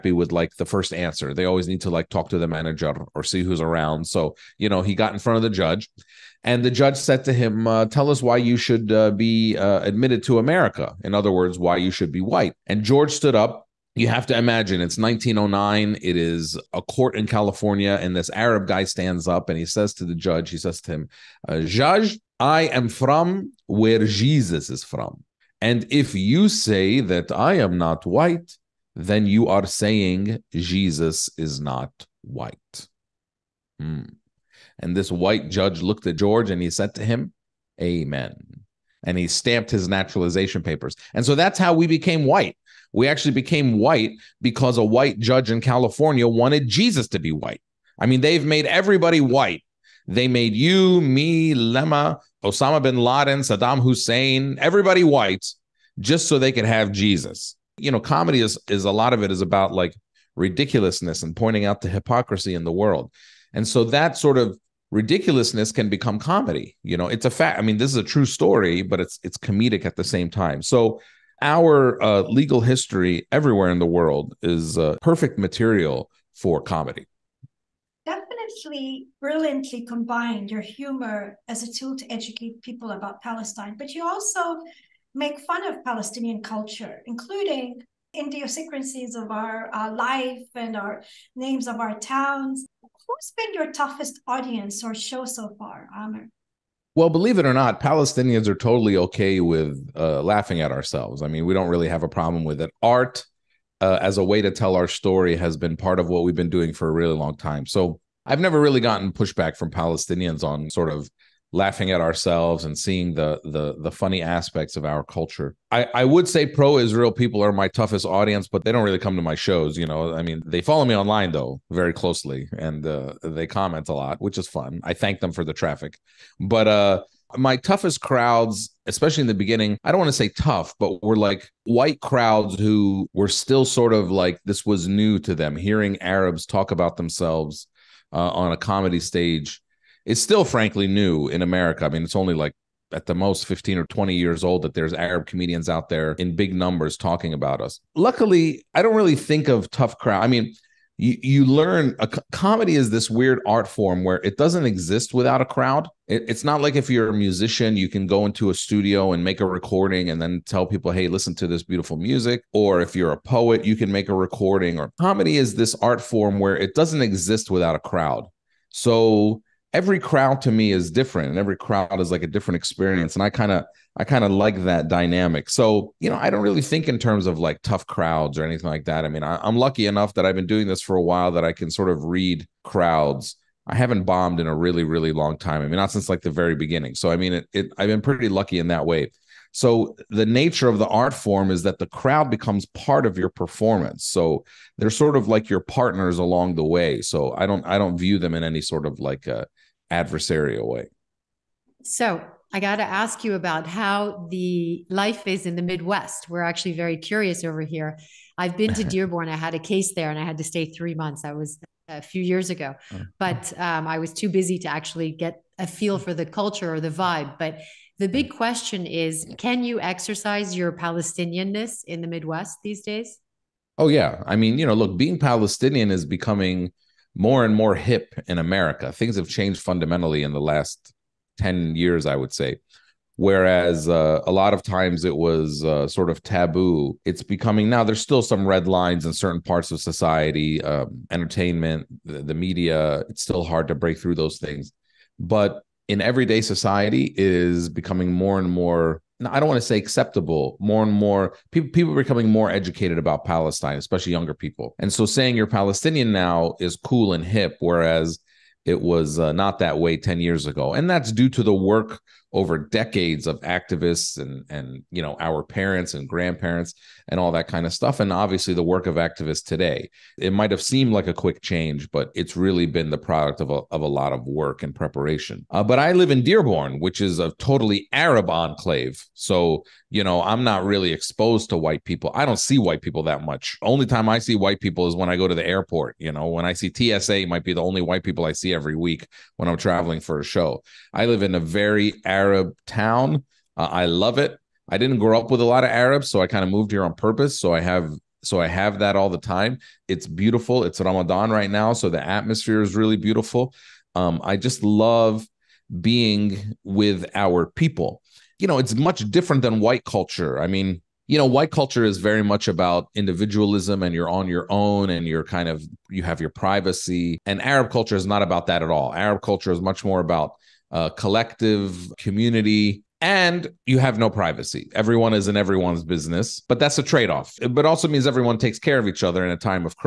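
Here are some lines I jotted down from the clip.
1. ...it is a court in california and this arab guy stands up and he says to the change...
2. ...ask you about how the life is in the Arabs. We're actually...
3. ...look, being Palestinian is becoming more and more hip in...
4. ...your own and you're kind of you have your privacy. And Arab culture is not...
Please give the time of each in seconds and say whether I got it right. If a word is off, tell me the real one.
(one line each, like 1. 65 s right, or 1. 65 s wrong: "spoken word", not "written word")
1. 16 s wrong: "judge", not "change"
2. 202 s wrong: "Midwest", not "Arabs"
3. 224 s right
4. 314 s right.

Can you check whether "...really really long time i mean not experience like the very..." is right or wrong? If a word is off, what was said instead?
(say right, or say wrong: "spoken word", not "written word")
wrong: "since", not "experience".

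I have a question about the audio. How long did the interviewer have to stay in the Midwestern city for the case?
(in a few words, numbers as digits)
3 months.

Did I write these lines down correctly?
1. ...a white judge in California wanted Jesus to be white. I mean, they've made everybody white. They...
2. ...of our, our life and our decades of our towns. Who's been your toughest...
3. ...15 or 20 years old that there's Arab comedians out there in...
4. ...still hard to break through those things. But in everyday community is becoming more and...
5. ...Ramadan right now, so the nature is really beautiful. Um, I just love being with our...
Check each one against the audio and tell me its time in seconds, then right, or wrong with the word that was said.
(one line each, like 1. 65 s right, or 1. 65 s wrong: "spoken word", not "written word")
1. 44 s right
2. 89 s wrong: "names", not "decades"
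3. 143 s right
4. 243 s wrong: "society", not "community"
5. 300 s wrong: "atmosphere", not "nature".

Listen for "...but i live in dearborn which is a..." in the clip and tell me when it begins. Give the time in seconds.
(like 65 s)
275 s.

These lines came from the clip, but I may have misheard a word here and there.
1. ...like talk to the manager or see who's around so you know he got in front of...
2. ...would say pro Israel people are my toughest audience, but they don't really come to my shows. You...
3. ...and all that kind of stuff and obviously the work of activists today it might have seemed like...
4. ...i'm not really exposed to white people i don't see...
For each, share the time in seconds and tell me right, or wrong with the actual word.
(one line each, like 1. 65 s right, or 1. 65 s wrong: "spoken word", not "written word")
1. 1 s right
2. 116 s right
3. 267 s right
4. 280 s right.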